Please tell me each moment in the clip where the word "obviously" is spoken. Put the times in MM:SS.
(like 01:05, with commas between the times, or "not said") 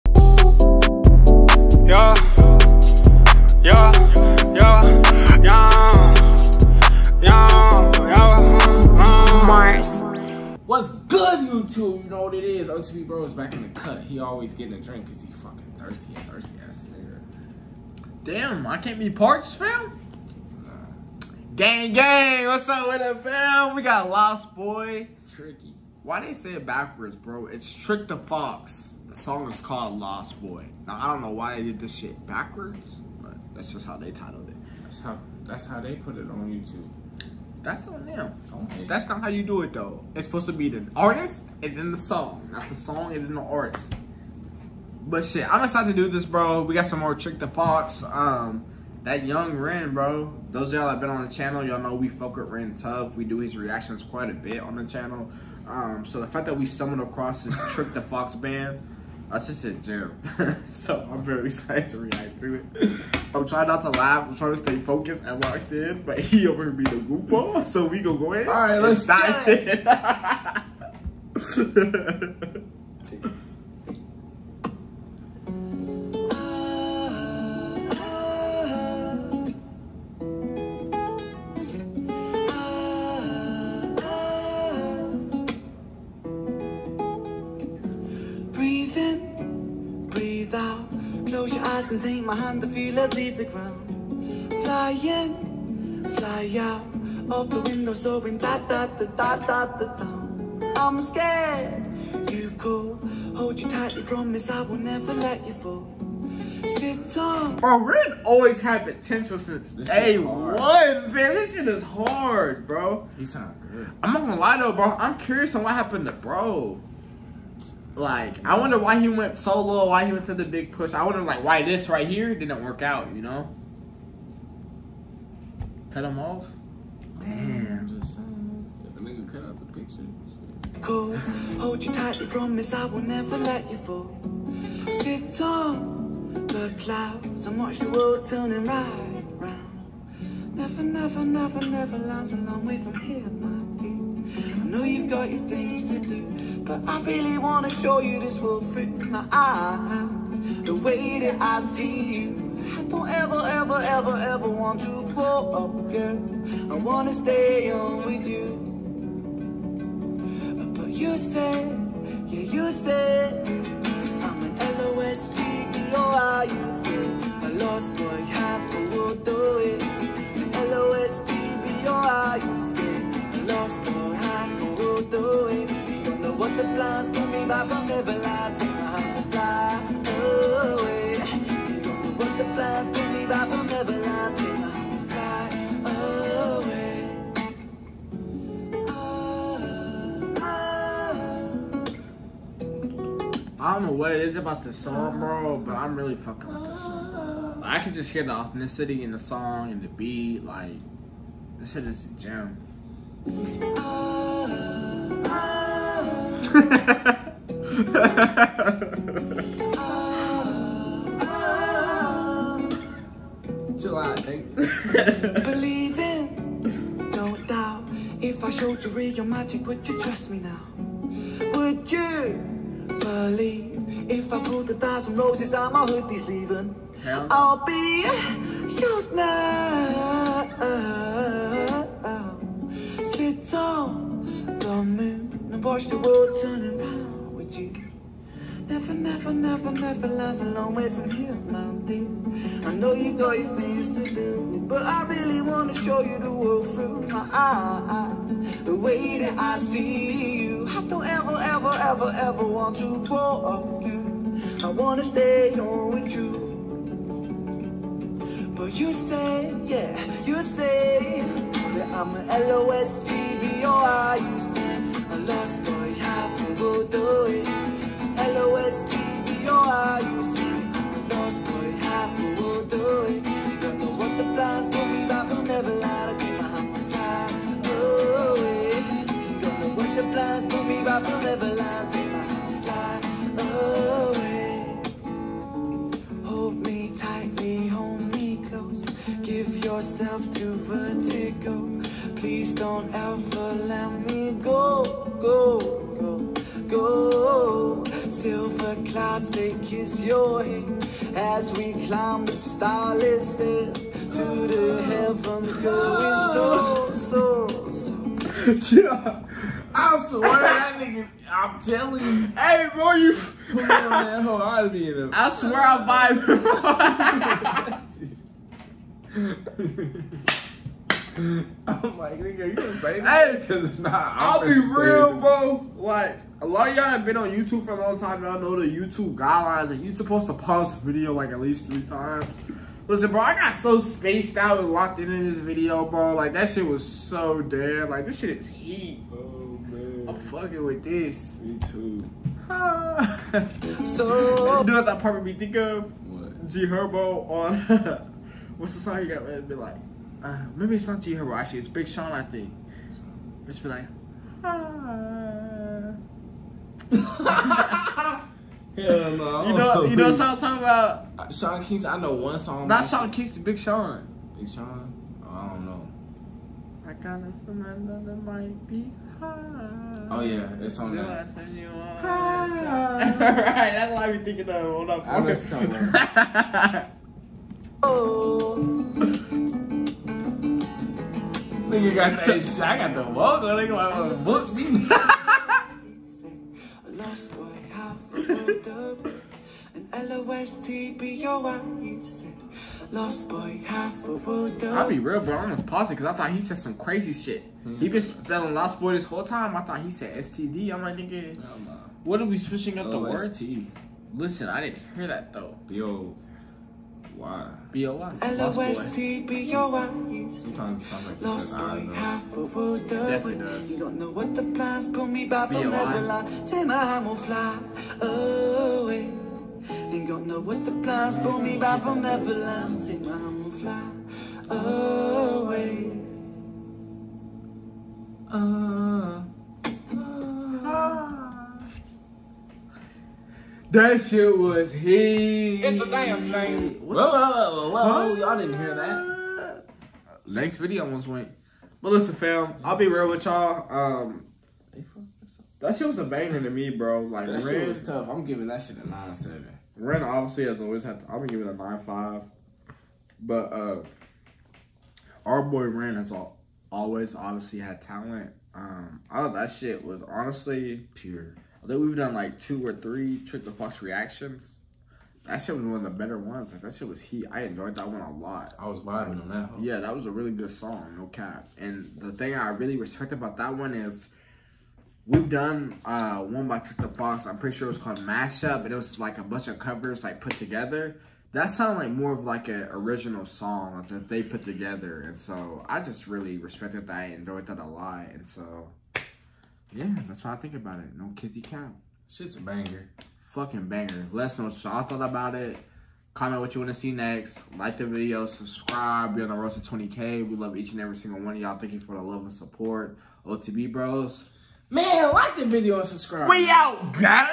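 07:30, 07:37.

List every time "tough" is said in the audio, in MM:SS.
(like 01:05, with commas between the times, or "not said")
00:52, 07:27.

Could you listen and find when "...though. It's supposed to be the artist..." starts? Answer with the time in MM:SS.
00:39.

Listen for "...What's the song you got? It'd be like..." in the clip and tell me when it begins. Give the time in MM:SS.
05:48.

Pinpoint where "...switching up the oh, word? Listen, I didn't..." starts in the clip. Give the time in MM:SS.
06:42.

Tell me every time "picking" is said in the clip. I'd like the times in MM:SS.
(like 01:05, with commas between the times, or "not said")
not said.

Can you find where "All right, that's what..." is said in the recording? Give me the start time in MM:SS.
06:12.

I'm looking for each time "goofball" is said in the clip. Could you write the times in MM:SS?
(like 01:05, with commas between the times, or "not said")
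01:06.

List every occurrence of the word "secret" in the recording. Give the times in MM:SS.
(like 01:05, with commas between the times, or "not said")
not said.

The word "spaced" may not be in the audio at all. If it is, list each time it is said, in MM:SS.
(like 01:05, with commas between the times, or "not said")
05:33.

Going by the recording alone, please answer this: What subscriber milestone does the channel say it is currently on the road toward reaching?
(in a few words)
20K.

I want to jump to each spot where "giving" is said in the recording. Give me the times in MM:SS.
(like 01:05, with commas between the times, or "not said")
07:28.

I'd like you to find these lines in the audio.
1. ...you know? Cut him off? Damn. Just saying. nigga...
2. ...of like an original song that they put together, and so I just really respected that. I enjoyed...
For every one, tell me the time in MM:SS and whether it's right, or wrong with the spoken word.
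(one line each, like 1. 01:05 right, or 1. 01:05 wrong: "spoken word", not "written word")
1. 02:03 right
2. 08:02 right.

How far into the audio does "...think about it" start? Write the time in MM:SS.
08:10.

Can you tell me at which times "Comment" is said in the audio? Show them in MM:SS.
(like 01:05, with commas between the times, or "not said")
08:16.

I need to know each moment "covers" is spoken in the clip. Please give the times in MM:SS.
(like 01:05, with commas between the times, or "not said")
07:59.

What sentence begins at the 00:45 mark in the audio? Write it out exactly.
But shit, I'm excited to do this, bro.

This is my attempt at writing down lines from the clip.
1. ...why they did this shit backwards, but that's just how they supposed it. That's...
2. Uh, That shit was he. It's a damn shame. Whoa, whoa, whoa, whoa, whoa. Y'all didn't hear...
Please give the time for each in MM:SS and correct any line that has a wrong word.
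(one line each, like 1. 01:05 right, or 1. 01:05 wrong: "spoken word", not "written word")
1. 00:31 wrong: "titled", not "supposed"
2. 07:08 right.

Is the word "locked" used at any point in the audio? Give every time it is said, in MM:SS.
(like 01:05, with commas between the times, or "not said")
01:05, 05:34.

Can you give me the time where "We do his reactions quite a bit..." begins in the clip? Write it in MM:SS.
00:53.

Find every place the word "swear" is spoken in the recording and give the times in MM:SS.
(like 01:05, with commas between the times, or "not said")
05:10, 05:15.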